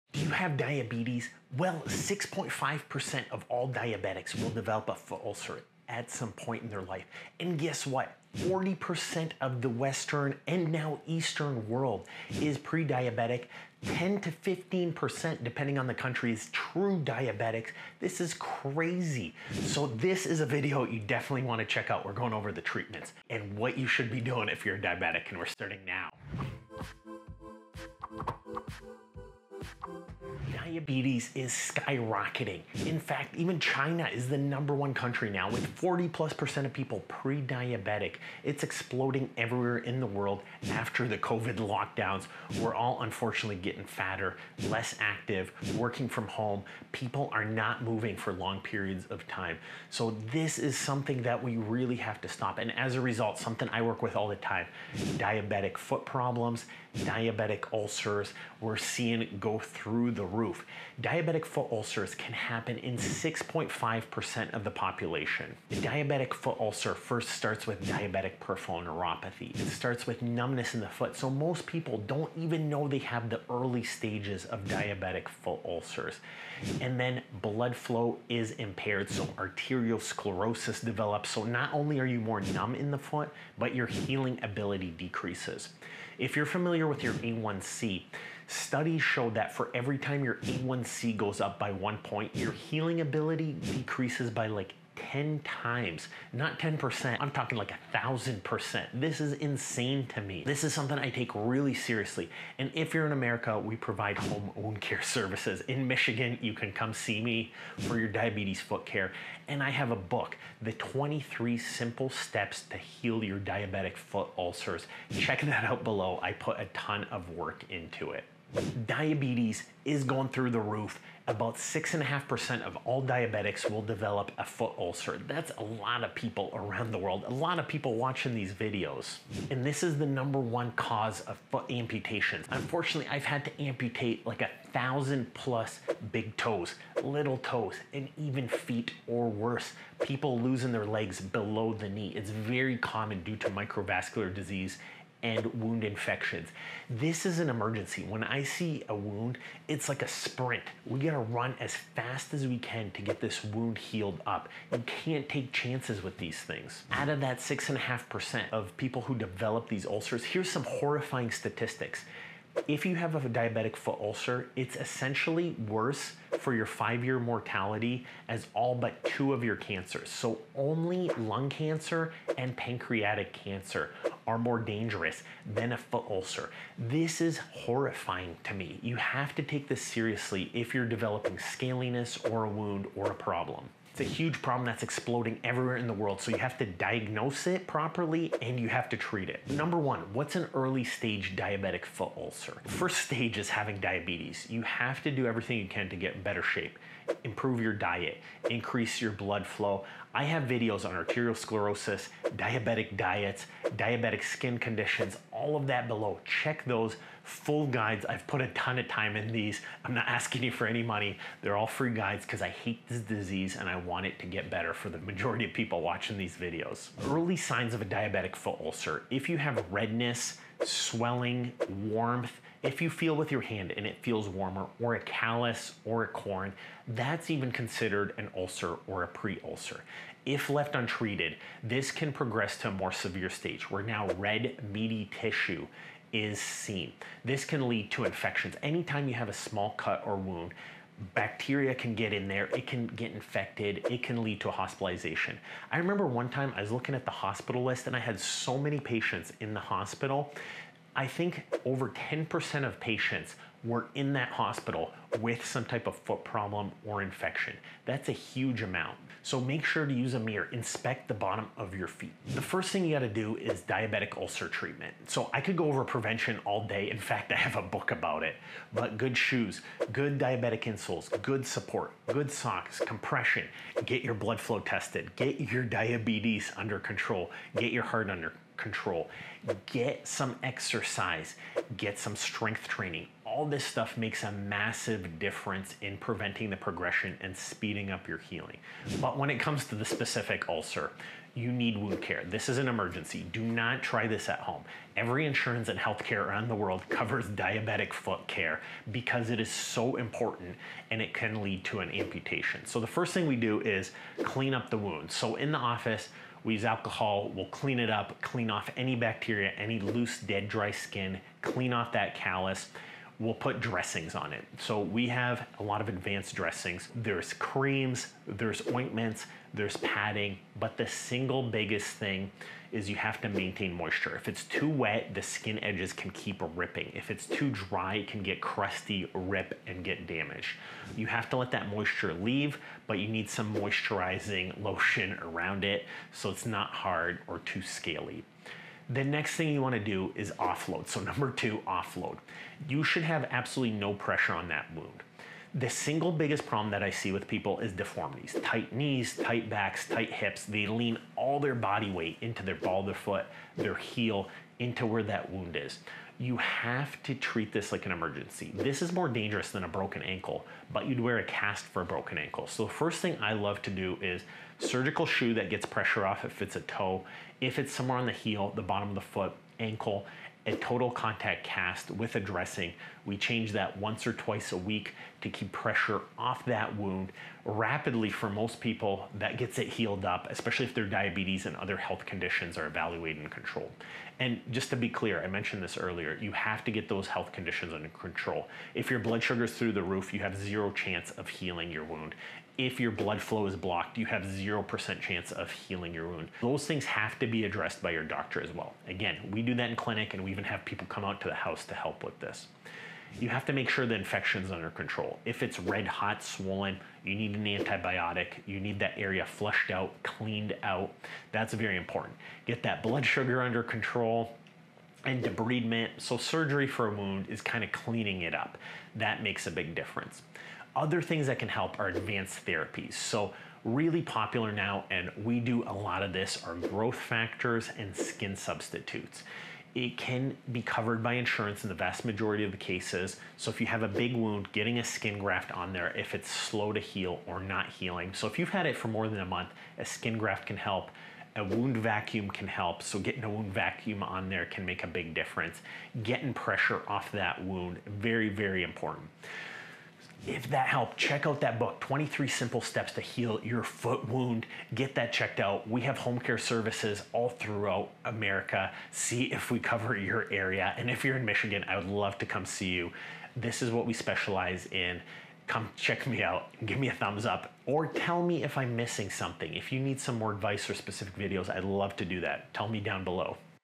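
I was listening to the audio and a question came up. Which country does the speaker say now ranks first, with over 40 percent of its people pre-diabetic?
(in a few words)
China.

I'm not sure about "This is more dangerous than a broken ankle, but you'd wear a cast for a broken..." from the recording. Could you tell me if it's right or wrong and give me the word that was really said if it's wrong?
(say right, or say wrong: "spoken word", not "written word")
right.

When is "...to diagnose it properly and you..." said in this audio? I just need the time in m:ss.
3:06.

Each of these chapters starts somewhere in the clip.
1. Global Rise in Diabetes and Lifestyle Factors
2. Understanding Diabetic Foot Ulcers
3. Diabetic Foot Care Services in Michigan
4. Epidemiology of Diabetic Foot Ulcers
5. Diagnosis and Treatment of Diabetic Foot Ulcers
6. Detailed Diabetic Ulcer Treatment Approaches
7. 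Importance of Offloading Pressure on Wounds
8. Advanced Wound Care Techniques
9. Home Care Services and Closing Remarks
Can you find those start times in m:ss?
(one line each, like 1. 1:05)
1. 0:30
2. 0:56
3. 1:42
4. 2:01
5. 3:06
6. 4:24
7. 6:02
8. 7:00
9. 7:34.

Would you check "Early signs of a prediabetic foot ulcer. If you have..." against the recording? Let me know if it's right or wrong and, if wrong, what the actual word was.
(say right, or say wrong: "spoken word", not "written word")
wrong: "diabetic", not "prediabetic".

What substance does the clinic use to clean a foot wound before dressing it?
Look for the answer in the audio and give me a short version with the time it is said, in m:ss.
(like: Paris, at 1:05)
Alcohol, at 5:06.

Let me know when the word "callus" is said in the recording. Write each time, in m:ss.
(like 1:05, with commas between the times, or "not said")
3:44, 5:12.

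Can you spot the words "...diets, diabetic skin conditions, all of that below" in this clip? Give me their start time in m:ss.
3:22.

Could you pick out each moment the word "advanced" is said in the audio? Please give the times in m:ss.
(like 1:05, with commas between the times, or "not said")
5:15, 7:01.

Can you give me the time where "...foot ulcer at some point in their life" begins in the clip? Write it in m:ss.
0:04.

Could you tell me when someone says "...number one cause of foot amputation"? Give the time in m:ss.
2:10.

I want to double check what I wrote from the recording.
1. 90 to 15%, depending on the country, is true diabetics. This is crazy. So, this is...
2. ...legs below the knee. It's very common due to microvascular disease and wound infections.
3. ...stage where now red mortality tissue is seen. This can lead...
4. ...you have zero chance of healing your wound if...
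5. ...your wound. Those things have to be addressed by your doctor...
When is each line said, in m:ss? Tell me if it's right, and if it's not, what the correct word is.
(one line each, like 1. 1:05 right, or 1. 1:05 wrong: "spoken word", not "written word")
1. 0:13 wrong: "10", not "90"
2. 2:20 right
3. 3:53 wrong: "meaty", not "mortality"
4. 6:30 right
5. 6:35 right.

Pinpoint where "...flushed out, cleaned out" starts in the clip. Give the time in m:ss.
6:49.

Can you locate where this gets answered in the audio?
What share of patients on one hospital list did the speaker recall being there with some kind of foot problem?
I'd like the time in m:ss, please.
4:11.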